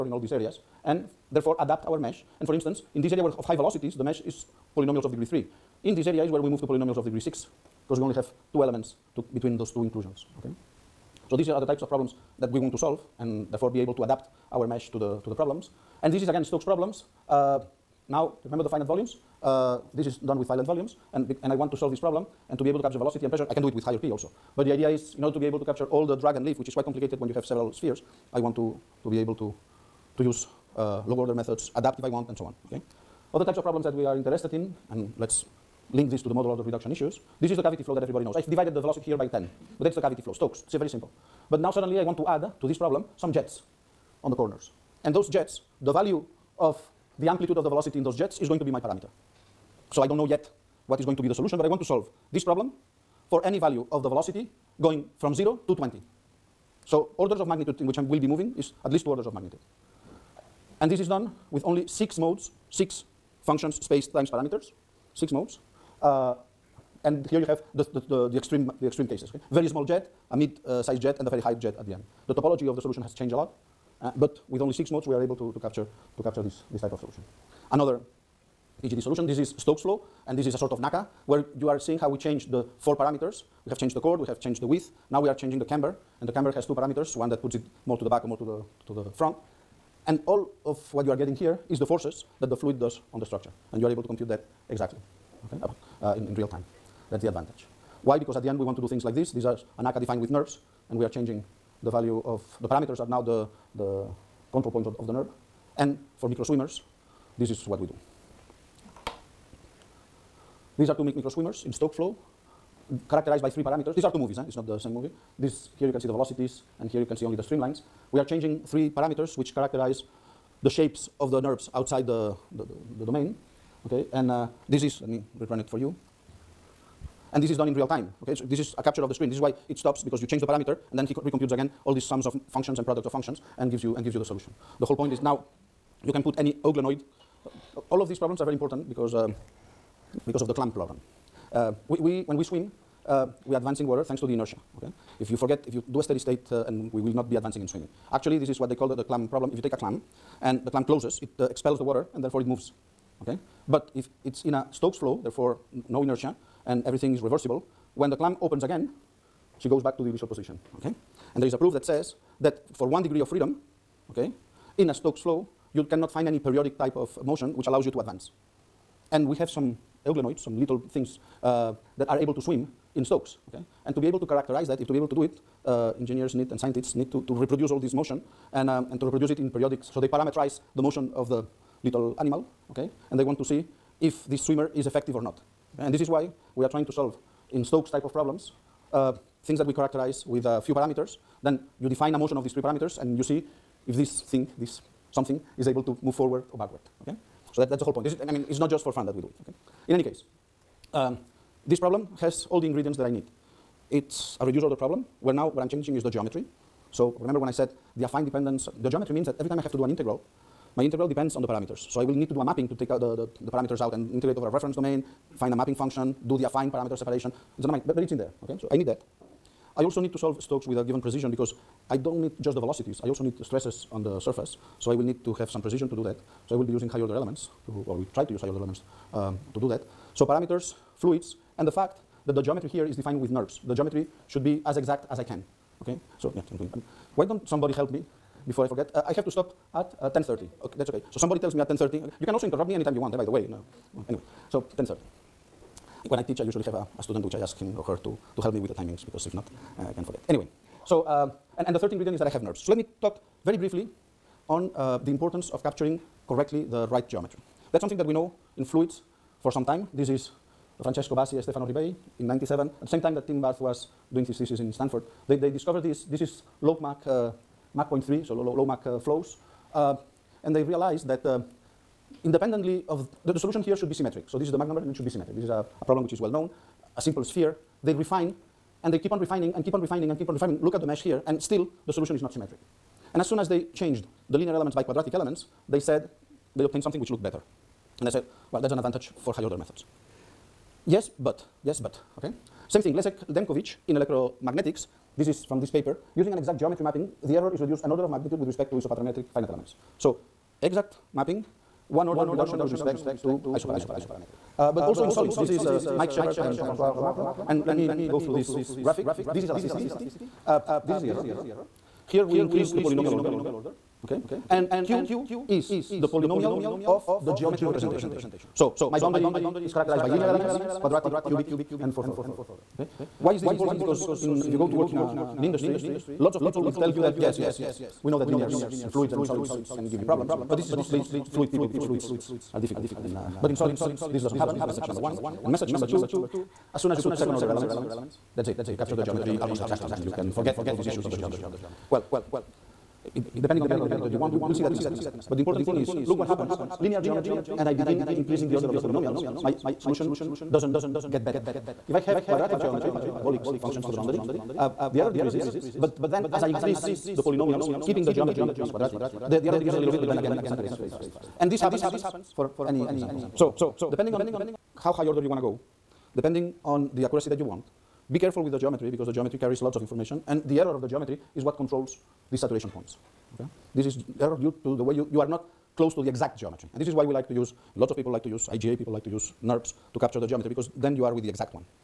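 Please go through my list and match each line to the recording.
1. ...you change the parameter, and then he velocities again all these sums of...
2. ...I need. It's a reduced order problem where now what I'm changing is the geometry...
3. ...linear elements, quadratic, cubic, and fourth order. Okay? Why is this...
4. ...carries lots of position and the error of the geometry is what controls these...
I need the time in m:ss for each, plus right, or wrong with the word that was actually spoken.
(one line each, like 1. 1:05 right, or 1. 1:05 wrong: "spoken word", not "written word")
1. 2:10 wrong: "recomputes", not "velocities"
2. 3:23 right
3. 5:20 right
4. 6:09 wrong: "information", not "position".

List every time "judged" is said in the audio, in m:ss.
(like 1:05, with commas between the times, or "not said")
not said.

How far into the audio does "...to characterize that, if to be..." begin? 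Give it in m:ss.
2:54.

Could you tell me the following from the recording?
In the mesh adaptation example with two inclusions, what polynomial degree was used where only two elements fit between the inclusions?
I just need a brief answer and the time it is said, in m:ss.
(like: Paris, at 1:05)
6, at 0:06.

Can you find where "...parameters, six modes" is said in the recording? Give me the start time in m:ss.
1:04.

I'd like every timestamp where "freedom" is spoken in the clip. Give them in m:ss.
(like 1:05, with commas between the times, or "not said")
2:43.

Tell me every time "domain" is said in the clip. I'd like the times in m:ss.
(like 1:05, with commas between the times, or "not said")
2:03, 3:34.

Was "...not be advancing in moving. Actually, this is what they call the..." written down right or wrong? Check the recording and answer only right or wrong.
wrong.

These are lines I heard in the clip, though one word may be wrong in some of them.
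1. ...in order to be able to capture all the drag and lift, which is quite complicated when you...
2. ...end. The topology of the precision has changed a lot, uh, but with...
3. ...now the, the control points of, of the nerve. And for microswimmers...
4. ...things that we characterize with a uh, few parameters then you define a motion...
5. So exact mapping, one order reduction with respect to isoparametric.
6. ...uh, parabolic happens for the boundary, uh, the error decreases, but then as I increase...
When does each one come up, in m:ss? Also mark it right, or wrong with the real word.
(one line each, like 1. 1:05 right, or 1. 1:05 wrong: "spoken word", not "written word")
1. 0:25 right
2. 1:11 wrong: "solution", not "precision"
3. 1:43 right
4. 3:09 right
5. 4:59 right
6. 5:52 wrong: "functions", not "happens".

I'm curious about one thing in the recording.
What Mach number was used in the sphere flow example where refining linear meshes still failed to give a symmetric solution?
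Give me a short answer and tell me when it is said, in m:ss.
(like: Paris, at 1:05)
0.3, at 4:27.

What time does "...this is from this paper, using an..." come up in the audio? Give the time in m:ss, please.
4:55.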